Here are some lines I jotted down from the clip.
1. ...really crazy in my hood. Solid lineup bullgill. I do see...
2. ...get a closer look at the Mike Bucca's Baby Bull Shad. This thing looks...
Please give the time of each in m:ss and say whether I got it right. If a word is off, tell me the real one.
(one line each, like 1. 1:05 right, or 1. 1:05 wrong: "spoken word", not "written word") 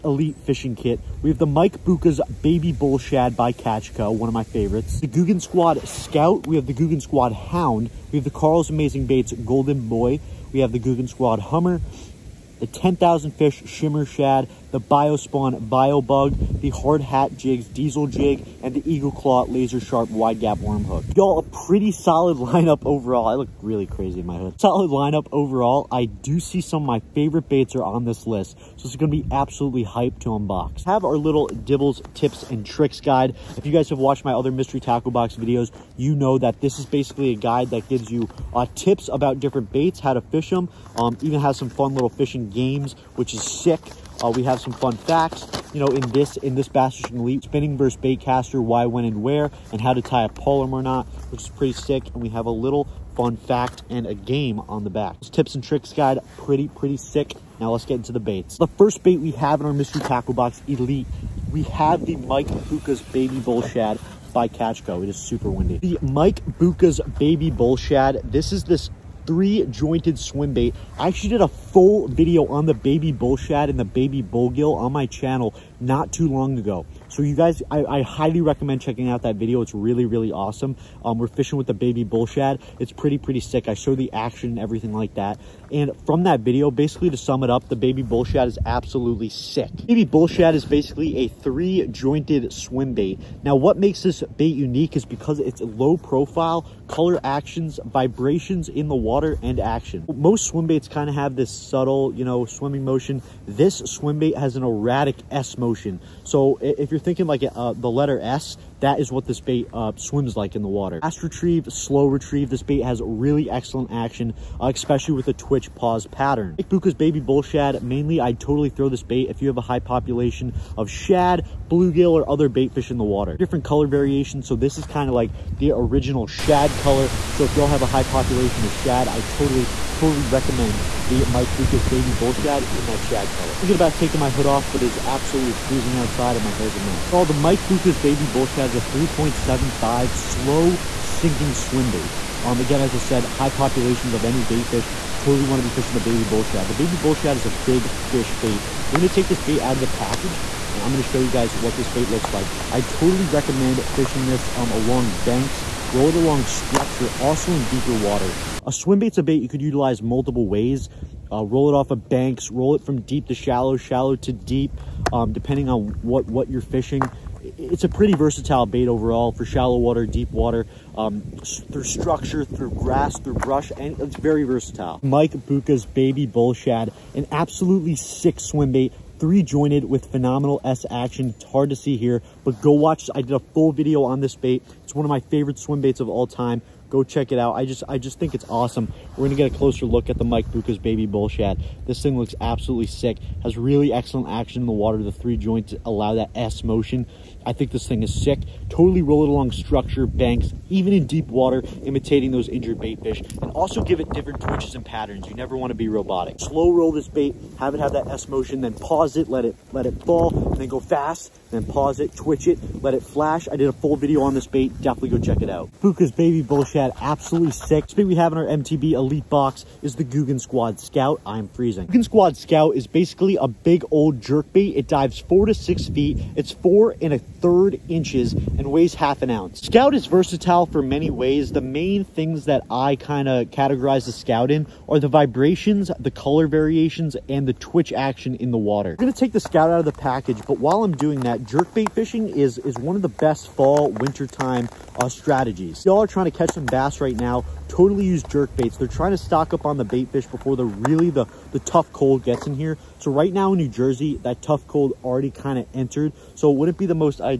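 1. 0:23 wrong: "overall", not "bullgill"
2. 3:09 right.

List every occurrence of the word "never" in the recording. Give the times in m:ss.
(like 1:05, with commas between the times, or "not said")
3:25.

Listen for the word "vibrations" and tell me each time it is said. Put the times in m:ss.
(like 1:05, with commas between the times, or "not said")
1:37, 3:55.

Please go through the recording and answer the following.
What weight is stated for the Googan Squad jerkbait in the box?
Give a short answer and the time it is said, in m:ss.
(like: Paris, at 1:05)
half an ounce, at 3:48.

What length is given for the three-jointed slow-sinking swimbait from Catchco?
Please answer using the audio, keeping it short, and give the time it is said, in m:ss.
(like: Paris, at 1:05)
3.75, at 2:18.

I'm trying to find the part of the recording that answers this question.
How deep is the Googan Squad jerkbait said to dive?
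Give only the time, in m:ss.
3:45.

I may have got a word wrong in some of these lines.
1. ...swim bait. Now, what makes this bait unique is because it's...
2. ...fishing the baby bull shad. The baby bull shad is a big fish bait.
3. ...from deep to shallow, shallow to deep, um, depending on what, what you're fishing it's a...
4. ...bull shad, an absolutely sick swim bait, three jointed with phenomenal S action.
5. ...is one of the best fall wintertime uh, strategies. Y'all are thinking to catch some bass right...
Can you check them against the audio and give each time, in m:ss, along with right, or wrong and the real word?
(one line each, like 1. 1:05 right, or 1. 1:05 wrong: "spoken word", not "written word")
1. 1:32 right
2. 2:25 right
3. 2:42 right
4. 2:56 right
5. 4:02 wrong: "trying", not "thinking".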